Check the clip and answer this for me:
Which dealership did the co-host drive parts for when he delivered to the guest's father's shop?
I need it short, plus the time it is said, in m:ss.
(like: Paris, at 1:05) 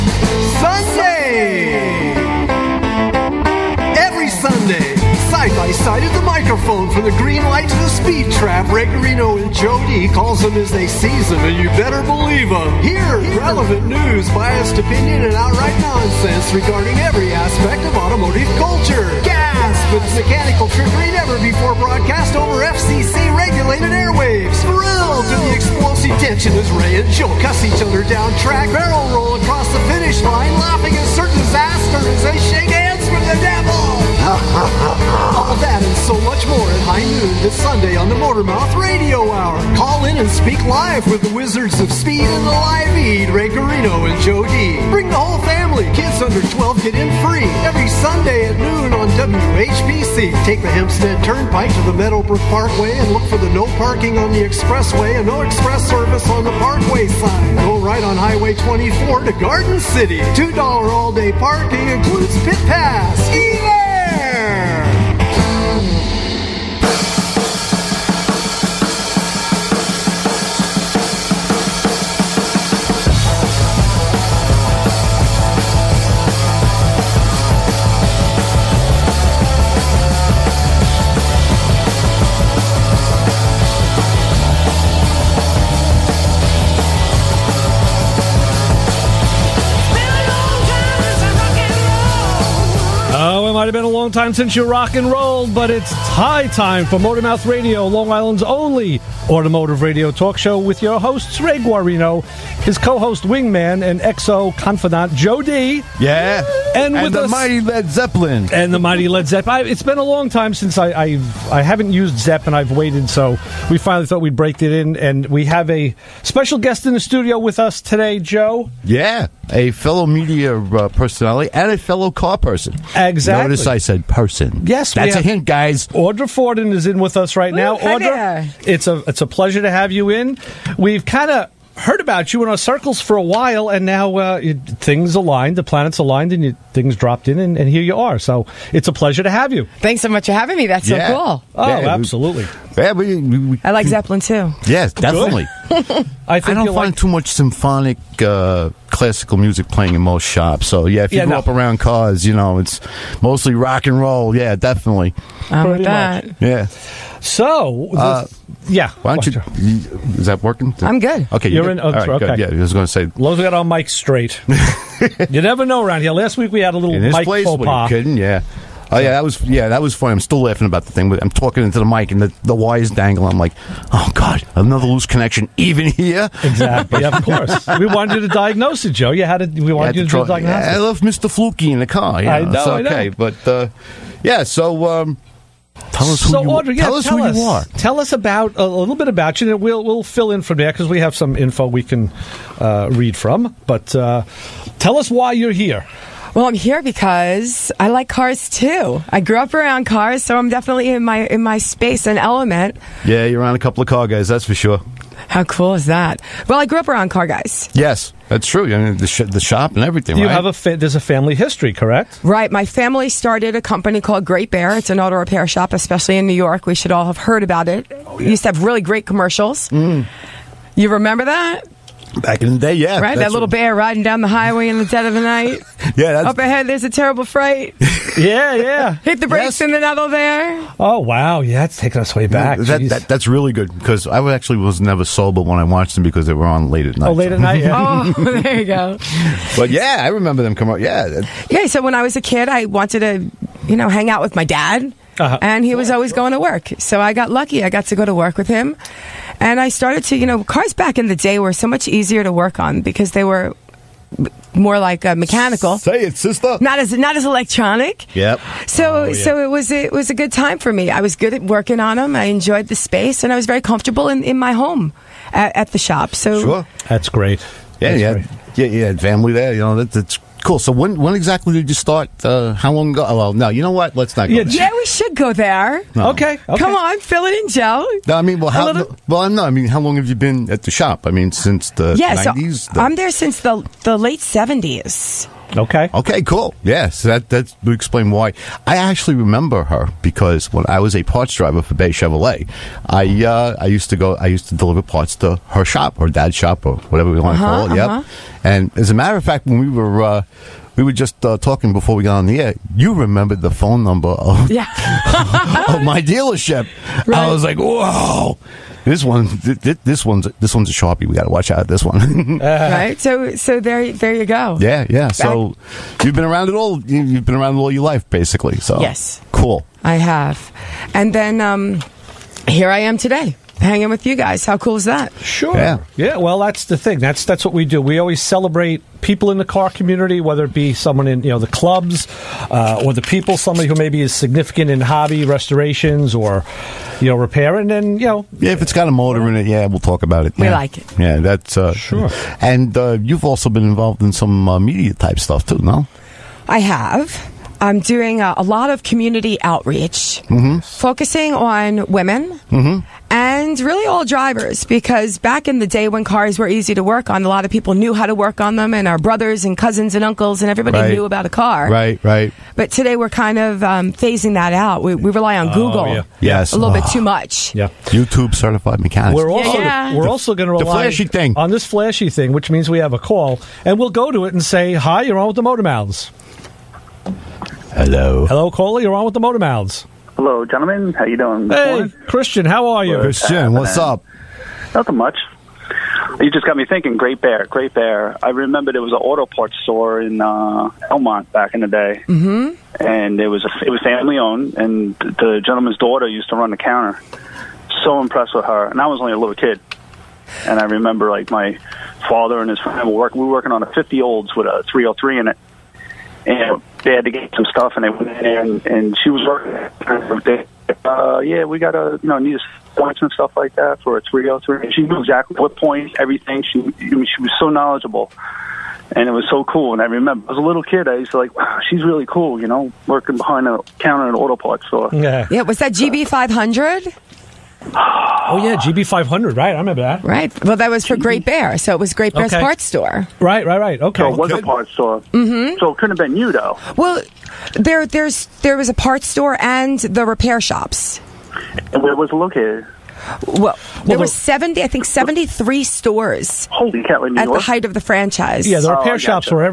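Bay Chevrolet, at 4:51.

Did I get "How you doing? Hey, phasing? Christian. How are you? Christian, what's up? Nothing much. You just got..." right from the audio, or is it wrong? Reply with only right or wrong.
wrong.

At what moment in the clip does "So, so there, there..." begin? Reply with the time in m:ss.
5:13.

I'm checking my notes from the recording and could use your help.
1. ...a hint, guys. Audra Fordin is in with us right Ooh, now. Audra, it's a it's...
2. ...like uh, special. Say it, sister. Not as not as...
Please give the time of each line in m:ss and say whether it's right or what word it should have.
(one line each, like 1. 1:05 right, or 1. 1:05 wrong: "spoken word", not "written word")
1. 2:05 right
2. 4:14 wrong: "mechanical", not "special".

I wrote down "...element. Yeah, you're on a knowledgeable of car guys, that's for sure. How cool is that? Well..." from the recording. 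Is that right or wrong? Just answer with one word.
wrong.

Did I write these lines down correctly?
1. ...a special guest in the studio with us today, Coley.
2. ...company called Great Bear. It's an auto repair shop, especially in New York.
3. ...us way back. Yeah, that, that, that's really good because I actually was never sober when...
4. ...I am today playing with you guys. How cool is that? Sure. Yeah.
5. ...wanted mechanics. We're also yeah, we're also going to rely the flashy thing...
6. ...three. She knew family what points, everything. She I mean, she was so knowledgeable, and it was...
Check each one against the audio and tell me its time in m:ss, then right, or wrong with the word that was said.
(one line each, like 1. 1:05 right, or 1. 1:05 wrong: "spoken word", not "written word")
1. 1:55 wrong: "Joe", not "Coley"
2. 3:33 right
3. 3:52 right
4. 5:22 wrong: "hanging", not "playing"
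5. 6:08 wrong: "certified", not "wanted"
6. 6:54 wrong: "exactly", not "family".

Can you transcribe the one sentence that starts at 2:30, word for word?
So yeah, if you yeah, grew no.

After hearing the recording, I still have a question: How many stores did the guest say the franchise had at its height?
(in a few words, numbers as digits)
73.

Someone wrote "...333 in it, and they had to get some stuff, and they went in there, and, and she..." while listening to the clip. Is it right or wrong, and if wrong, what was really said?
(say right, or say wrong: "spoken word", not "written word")
wrong: "303", not "333".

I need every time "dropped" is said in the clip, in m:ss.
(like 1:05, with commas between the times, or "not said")
2:16.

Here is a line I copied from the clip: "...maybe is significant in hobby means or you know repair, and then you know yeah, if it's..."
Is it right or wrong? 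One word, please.
wrong.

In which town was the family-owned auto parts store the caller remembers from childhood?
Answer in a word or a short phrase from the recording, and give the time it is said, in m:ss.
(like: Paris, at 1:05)
Elmont, at 6:30.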